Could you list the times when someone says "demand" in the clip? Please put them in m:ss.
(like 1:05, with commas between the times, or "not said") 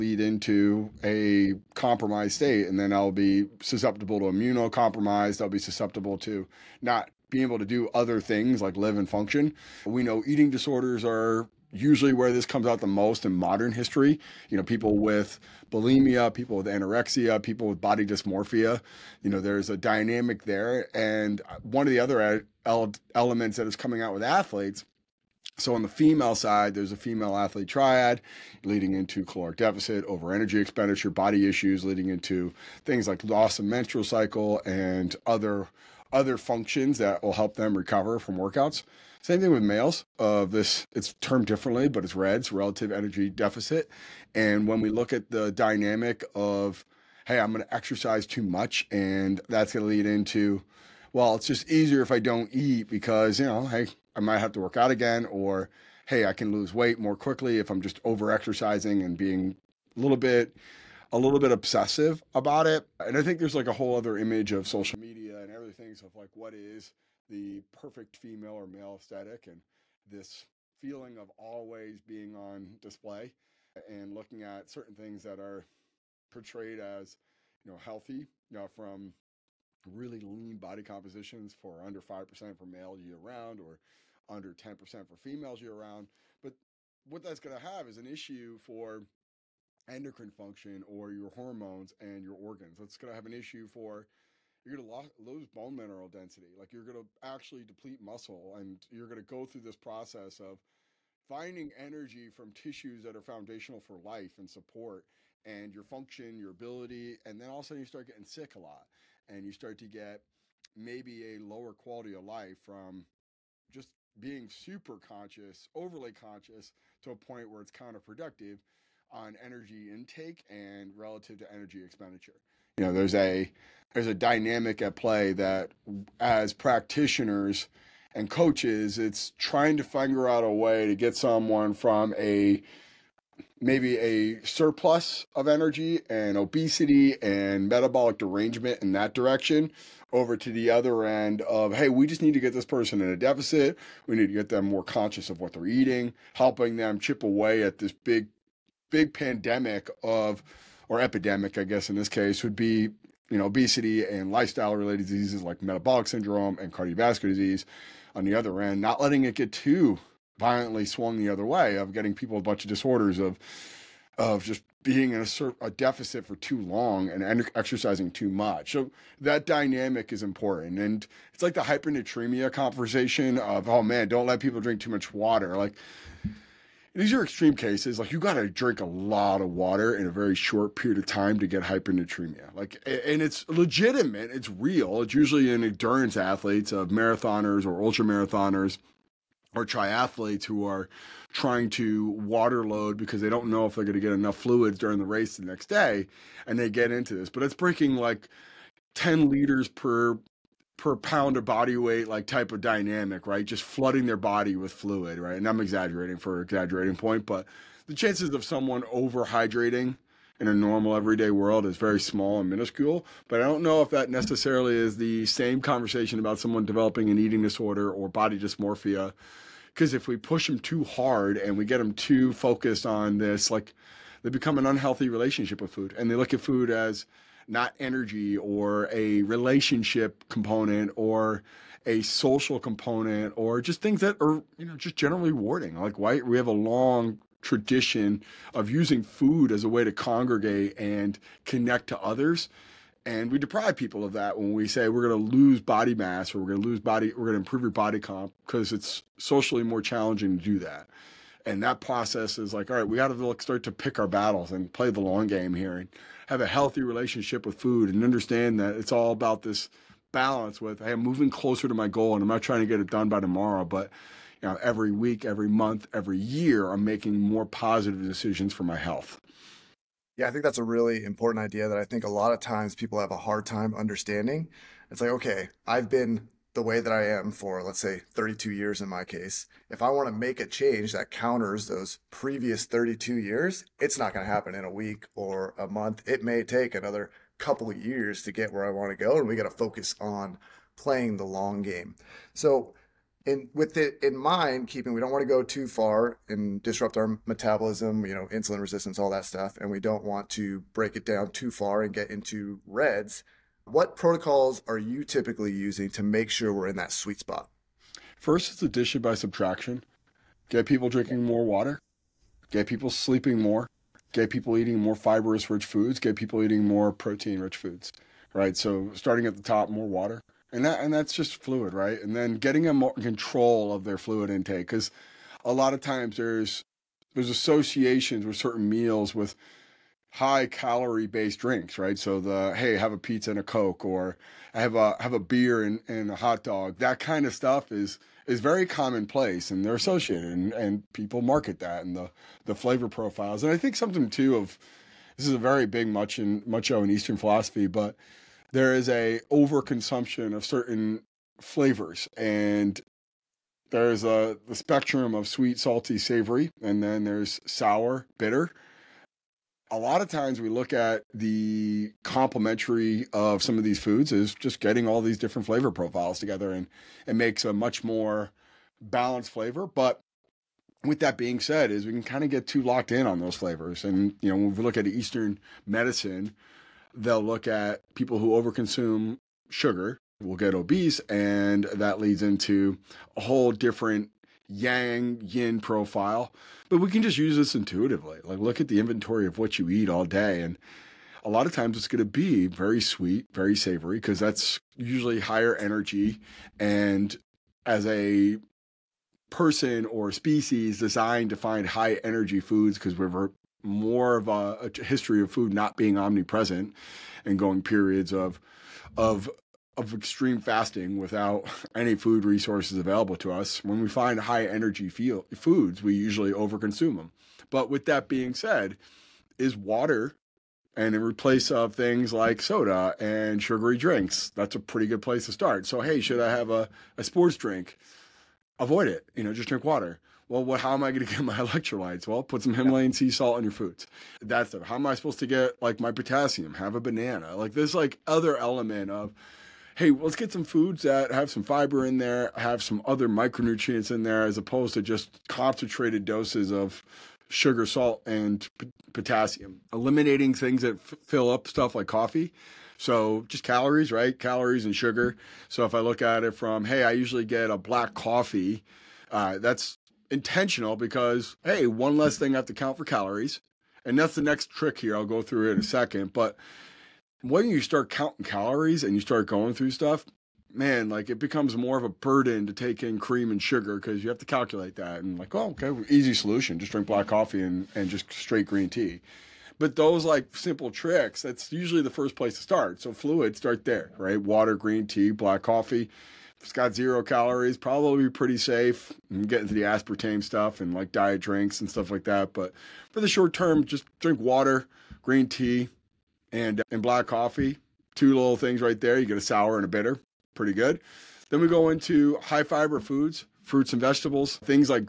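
not said.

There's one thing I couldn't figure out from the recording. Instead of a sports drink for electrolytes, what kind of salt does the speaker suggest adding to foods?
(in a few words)
Himalayan sea salt.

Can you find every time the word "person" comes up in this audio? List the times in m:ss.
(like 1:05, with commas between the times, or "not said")
2:22, 6:39.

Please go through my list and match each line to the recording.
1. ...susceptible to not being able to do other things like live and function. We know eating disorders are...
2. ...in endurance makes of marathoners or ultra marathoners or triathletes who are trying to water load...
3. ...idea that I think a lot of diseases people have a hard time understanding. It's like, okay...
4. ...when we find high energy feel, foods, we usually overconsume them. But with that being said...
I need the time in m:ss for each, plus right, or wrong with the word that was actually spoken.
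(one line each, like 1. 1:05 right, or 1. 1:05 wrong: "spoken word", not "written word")
1. 0:05 right
2. 3:05 wrong: "athletes", not "makes"
3. 4:31 wrong: "times", not "diseases"
4. 6:53 right.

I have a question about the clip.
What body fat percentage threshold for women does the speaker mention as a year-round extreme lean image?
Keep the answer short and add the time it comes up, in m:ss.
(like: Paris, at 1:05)
under 10%, at 1:24.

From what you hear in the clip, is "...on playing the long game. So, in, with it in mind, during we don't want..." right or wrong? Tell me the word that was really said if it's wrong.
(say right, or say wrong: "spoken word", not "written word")
wrong: "keeping", not "during".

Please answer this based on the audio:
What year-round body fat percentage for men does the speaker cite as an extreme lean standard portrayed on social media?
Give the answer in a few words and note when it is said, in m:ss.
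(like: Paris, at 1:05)
under 5%, at 1:21.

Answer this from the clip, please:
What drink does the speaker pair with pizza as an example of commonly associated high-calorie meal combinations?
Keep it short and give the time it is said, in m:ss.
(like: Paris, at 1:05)
coke, at 5:33.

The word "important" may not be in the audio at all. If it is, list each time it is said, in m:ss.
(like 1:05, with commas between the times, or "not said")
2:50, 4:31.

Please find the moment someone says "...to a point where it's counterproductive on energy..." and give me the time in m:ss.
1:57.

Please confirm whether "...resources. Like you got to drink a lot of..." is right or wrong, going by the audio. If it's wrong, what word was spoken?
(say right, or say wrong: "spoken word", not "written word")
wrong: "cases", not "resources".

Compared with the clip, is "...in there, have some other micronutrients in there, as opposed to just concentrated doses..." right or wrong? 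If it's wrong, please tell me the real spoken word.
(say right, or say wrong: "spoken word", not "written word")
right.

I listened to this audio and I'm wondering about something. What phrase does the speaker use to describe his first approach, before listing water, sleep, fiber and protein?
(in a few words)
addition by subtraction.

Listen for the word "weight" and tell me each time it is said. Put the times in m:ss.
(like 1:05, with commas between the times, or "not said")
0:56, 3:21.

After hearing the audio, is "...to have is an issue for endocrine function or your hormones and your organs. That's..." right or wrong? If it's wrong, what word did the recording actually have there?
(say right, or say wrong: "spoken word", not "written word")
right.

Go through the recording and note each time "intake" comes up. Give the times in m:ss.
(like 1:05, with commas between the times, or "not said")
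1:59, 5:24.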